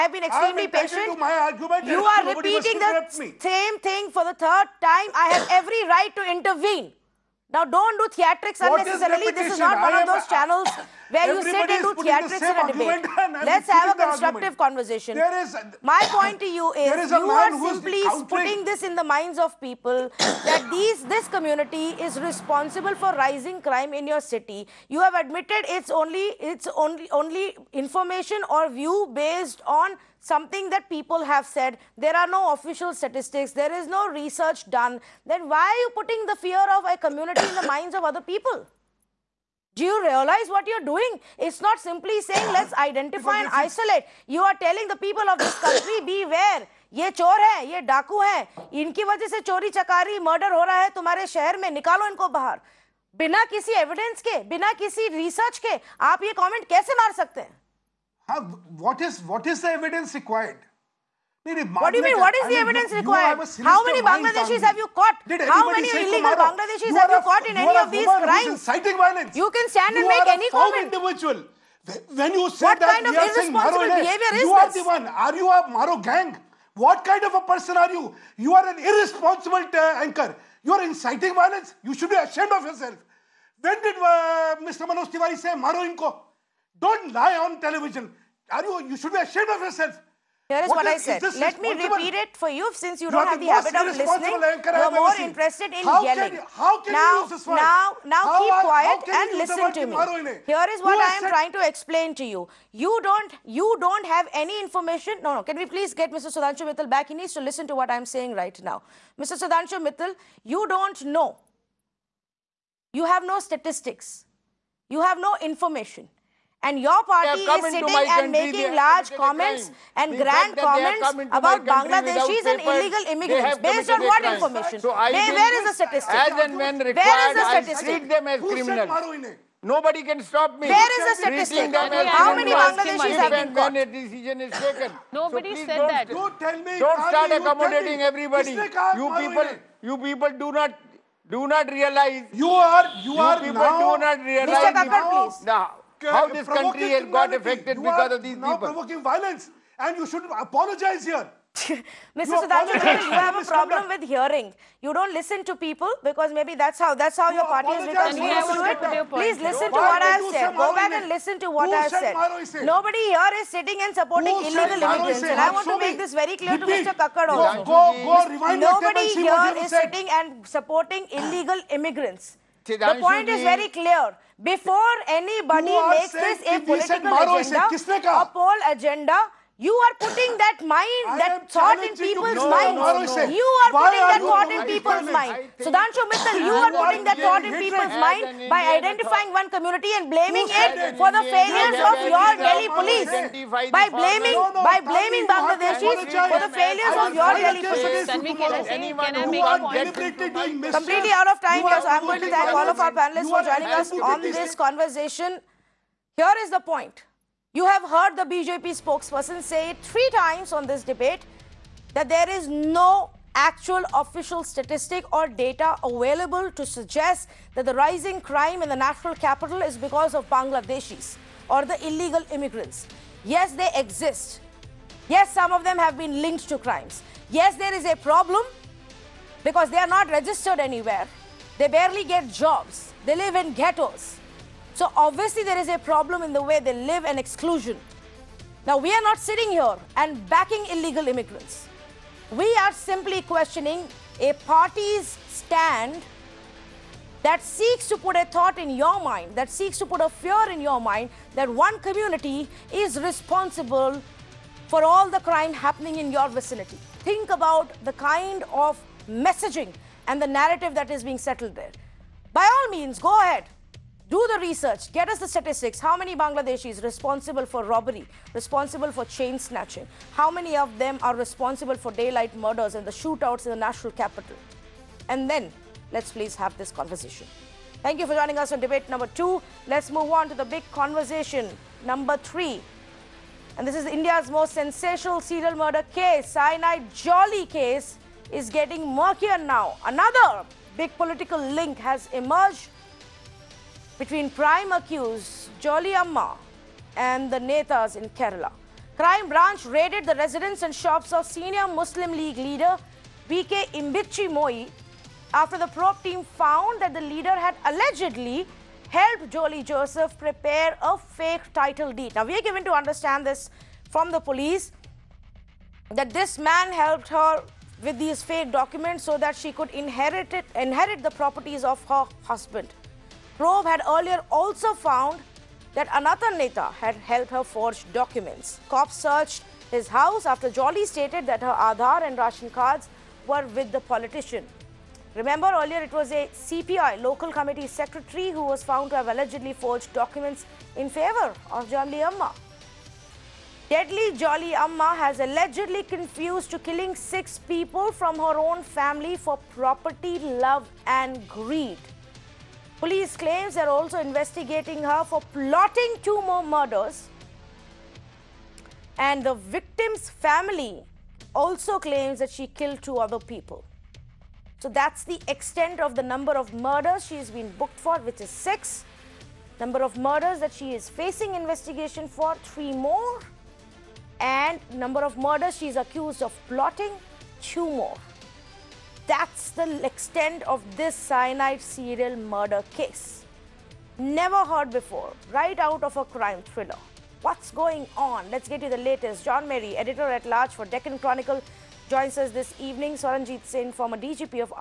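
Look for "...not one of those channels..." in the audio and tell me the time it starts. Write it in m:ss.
0:09.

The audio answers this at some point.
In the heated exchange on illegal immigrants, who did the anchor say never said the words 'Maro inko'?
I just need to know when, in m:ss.
1:24.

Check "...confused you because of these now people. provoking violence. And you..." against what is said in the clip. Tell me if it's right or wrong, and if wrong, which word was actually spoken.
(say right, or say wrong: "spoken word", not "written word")
wrong: "affected", not "confused".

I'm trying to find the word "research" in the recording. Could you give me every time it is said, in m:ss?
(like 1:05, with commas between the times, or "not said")
0:34, 4:24.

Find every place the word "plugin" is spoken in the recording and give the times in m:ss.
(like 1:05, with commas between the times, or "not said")
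not said.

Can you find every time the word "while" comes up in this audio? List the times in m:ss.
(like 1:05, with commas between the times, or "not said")
not said.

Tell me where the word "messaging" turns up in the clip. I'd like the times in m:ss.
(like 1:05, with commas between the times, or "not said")
4:19.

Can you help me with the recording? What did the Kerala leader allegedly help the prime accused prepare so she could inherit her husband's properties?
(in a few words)
A fake title deed.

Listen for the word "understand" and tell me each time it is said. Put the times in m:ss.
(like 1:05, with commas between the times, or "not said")
5:12.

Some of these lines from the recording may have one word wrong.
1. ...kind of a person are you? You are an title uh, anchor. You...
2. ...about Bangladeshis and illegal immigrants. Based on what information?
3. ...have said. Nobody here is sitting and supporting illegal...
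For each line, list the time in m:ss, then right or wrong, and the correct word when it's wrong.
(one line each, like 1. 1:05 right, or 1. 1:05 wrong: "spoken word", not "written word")
1. 1:17 wrong: "irresponsible", not "title"
2. 2:01 right
3. 2:41 right.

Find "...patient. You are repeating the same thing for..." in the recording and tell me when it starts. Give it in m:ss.
0:00.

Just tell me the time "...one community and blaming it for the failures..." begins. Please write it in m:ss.
3:09.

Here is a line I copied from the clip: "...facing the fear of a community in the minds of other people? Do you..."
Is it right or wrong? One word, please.
wrong.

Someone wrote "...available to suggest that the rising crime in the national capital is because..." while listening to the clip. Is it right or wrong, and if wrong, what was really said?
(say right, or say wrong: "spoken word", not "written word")
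right.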